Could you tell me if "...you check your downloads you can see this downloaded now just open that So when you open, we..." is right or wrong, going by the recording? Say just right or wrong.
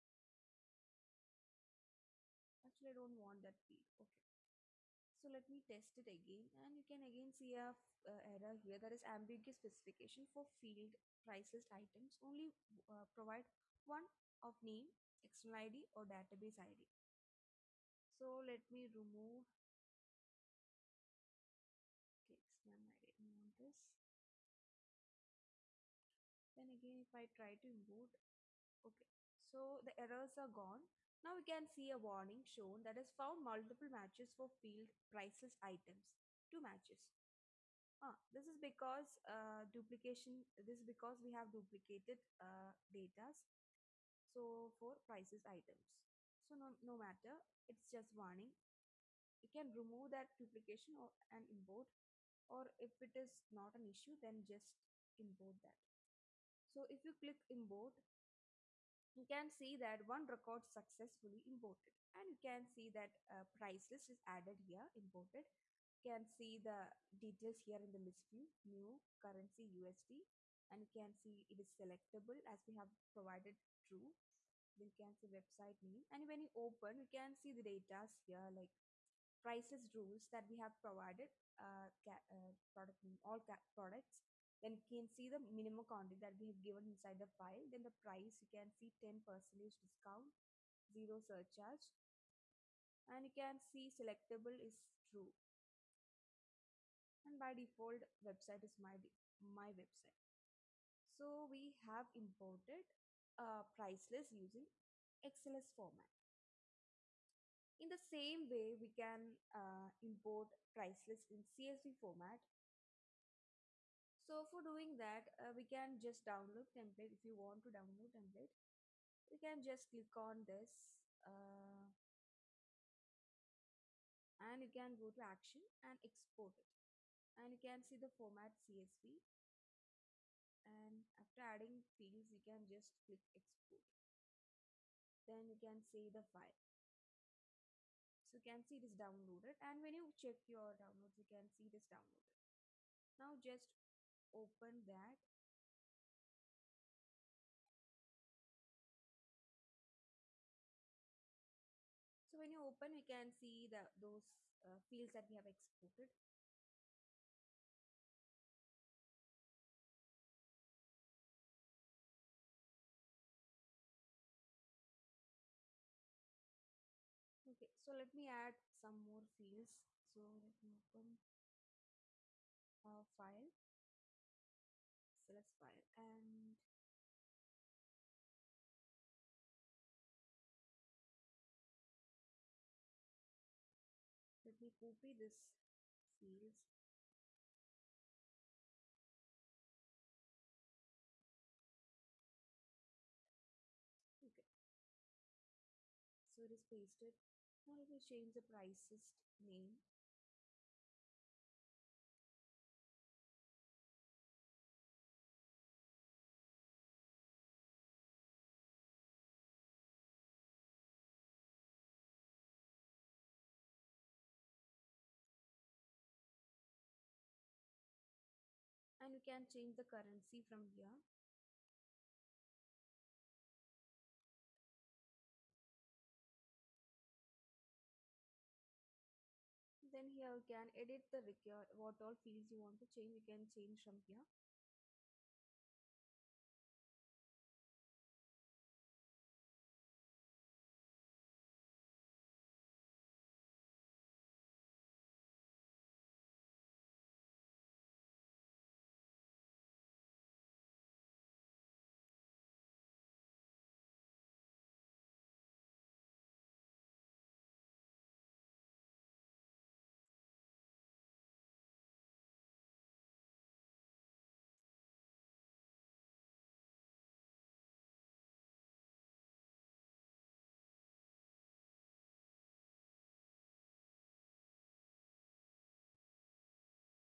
right.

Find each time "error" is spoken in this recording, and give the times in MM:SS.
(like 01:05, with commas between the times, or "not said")
00:08, 00:30.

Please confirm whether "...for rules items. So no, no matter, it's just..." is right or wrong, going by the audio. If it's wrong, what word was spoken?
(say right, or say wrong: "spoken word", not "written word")
wrong: "prices", not "rules".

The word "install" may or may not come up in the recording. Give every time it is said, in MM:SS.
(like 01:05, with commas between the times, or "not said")
not said.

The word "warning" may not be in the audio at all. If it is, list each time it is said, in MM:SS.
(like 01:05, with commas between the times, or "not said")
00:32, 00:48.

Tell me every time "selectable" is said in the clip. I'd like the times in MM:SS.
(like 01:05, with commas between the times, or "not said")
01:11, 01:33.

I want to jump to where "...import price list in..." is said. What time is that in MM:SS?
01:50.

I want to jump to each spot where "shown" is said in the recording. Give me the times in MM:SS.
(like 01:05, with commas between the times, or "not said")
00:32.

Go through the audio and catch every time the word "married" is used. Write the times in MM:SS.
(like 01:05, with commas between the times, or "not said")
not said.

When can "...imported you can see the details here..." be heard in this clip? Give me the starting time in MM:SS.
01:04.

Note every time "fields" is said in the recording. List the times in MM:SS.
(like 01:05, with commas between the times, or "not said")
00:03, 00:10, 00:34, 02:11, 02:34, 02:49, 03:06, 03:52.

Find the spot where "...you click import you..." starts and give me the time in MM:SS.
00:57.